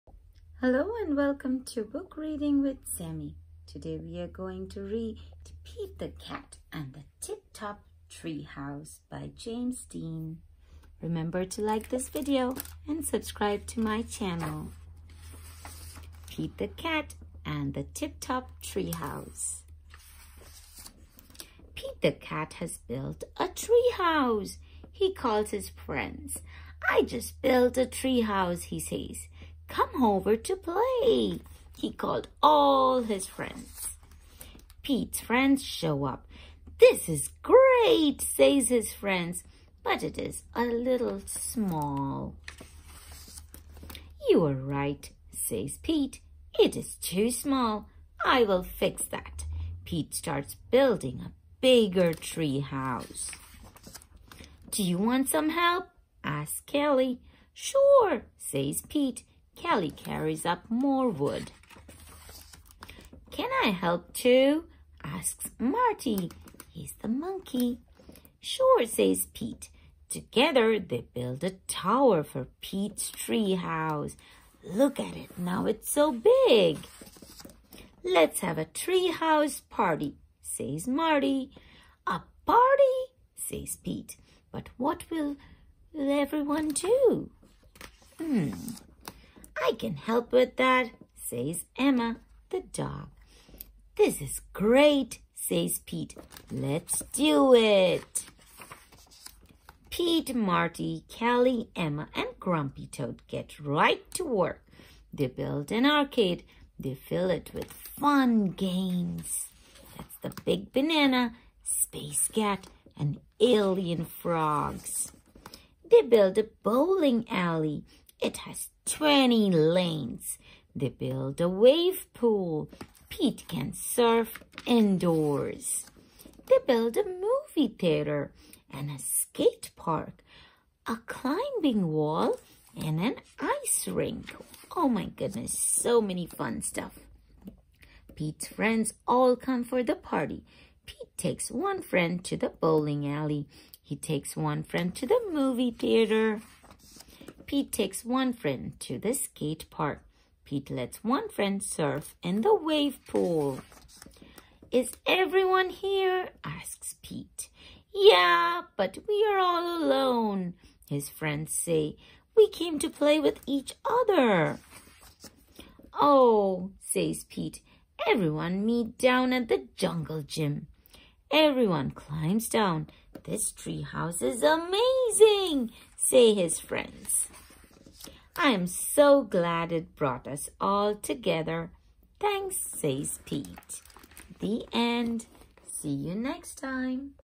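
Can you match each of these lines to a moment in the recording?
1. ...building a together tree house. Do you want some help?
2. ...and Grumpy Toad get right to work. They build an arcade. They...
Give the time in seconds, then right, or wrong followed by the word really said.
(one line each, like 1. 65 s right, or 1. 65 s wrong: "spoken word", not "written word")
1. 50 s wrong: "bigger", not "together"
2. 102 s right.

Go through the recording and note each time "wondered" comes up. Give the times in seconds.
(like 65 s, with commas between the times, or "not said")
not said.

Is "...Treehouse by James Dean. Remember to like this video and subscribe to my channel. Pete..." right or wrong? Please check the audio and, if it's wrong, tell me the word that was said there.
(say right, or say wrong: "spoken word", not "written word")
right.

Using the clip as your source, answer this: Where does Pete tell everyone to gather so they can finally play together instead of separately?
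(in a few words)
The jungle gym.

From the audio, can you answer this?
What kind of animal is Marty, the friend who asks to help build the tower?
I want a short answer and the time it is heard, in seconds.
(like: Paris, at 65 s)
Monkey, at 67 s.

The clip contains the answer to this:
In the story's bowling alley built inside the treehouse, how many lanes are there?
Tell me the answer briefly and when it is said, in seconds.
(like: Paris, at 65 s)
20, at 118 s.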